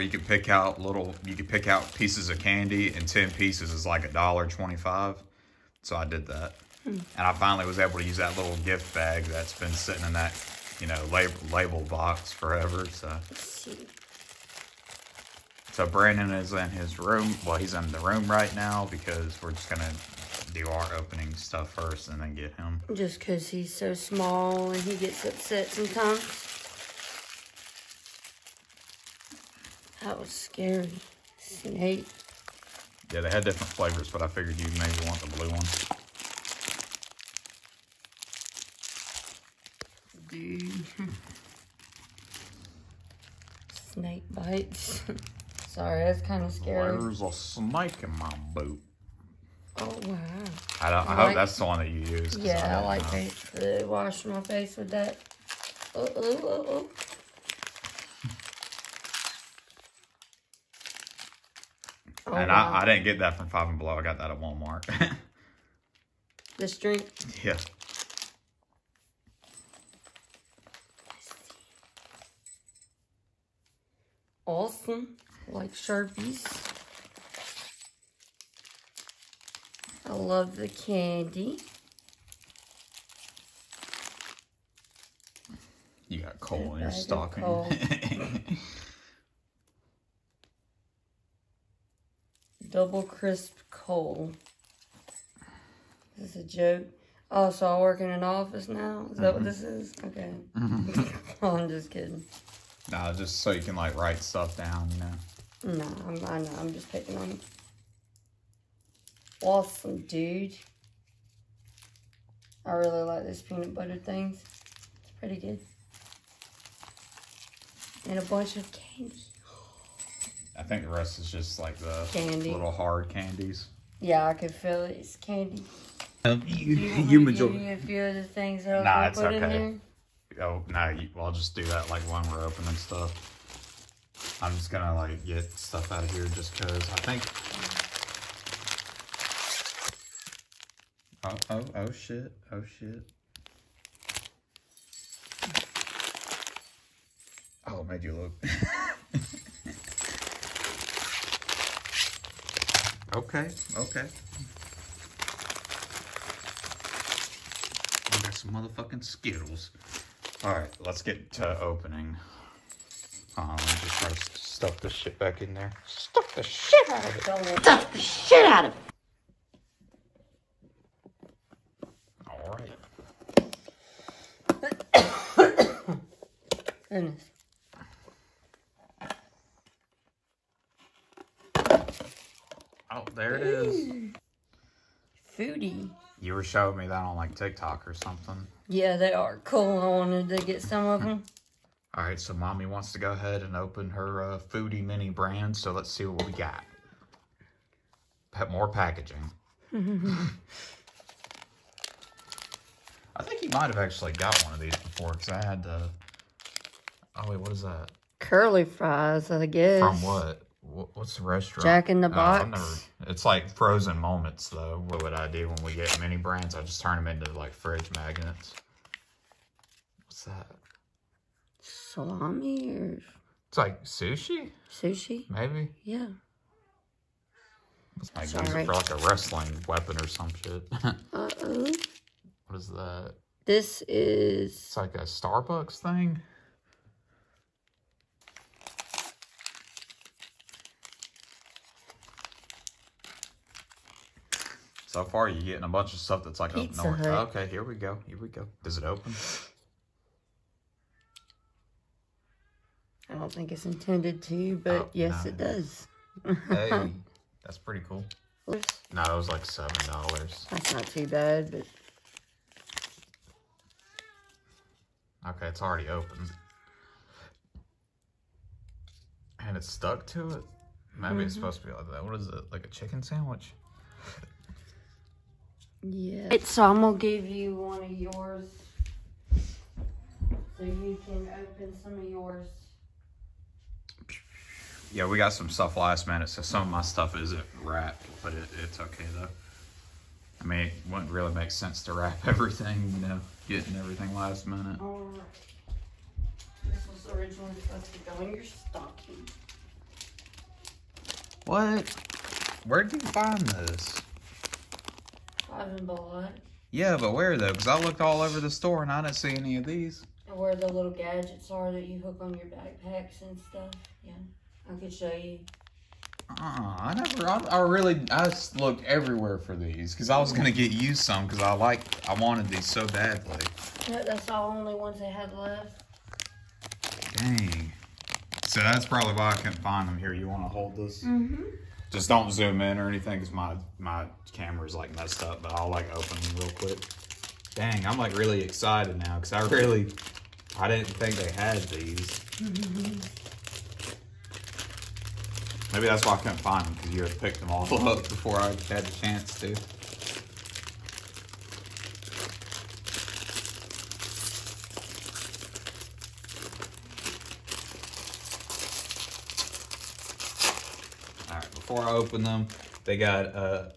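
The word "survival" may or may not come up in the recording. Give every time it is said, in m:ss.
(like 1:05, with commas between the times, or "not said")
not said.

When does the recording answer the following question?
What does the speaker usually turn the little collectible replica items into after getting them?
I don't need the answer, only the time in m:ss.
3:37.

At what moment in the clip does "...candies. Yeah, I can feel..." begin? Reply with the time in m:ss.
2:03.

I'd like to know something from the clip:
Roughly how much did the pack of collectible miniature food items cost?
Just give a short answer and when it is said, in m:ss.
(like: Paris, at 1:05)
$7, at 4:19.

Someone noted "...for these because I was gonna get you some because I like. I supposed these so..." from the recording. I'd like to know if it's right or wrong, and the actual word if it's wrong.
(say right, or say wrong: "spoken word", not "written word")
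wrong: "wanted", not "supposed".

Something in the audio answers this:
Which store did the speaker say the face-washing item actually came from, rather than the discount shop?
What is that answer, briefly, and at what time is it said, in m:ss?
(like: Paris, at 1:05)
Walmart, at 1:04.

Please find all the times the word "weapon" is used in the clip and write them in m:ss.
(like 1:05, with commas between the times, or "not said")
3:49.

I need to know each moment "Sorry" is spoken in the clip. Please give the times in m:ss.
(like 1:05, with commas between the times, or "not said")
0:45, 3:48.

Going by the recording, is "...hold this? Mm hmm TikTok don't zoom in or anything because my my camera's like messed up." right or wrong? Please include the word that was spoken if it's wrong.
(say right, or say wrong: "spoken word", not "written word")
wrong: "Just", not "TikTok".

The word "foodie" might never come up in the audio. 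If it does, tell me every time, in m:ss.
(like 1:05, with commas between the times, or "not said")
3:05, 3:14.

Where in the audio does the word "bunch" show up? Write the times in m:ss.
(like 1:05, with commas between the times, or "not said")
1:58, 4:05.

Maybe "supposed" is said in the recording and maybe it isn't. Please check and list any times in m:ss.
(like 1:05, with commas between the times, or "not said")
4:31, 4:57.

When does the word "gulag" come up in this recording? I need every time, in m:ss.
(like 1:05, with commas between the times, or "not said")
not said.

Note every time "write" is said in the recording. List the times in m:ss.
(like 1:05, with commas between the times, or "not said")
1:43.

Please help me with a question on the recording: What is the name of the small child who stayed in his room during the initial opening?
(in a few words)
Brandon.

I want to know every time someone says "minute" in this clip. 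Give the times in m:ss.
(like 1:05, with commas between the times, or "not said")
4:46, 4:54.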